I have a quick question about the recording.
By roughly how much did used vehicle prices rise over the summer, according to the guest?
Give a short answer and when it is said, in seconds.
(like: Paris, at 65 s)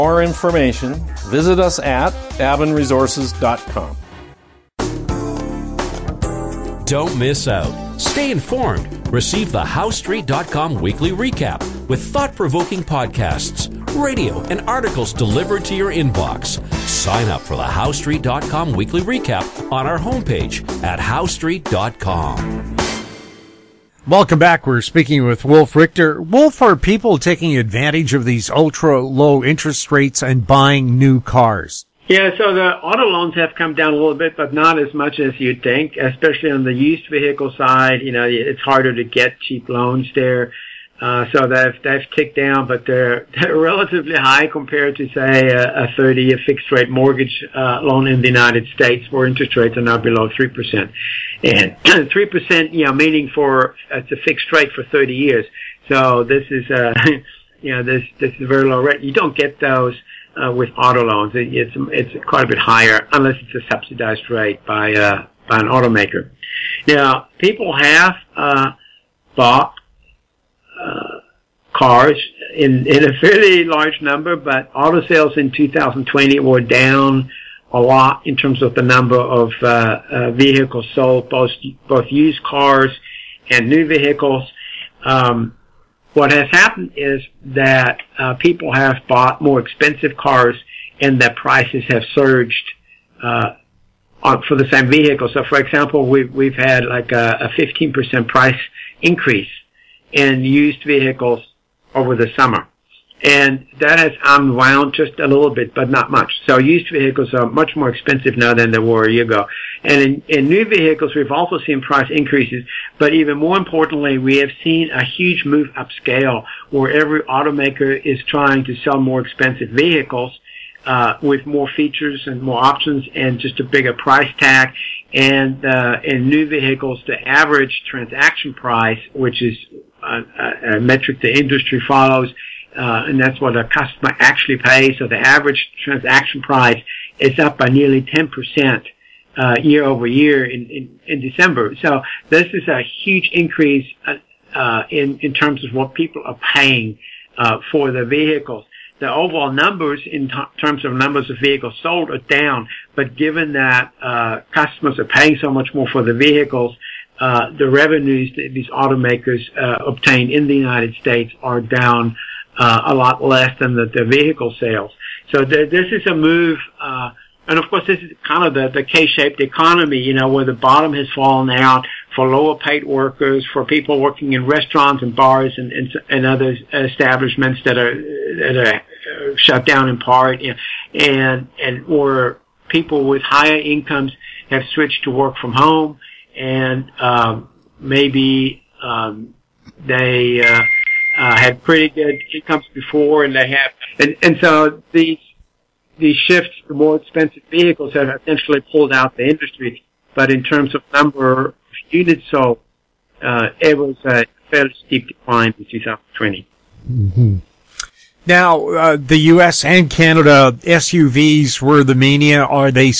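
15%, at 97 s.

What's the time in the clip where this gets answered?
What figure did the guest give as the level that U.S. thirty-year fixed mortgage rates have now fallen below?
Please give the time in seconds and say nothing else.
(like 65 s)
49 s.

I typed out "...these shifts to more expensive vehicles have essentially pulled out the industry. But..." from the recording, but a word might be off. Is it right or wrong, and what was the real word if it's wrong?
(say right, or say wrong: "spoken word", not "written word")
right.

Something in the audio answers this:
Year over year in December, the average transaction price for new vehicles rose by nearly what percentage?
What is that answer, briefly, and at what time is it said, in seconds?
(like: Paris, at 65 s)
10%, at 138 s.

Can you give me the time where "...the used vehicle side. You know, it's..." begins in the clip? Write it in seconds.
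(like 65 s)
36 s.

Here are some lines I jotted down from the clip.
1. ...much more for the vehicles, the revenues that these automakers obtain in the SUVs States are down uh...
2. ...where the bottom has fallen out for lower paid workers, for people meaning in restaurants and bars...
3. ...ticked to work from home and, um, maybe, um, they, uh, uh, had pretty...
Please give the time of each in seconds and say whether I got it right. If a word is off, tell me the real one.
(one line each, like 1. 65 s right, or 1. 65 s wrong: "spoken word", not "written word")
1. 155 s wrong: "United", not "SUVs"
2. 170 s wrong: "working", not "meaning"
3. 184 s wrong: "switched", not "ticked".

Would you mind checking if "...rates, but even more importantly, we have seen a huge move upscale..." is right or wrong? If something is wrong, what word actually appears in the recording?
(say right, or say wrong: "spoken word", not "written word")
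wrong: "increases", not "rates".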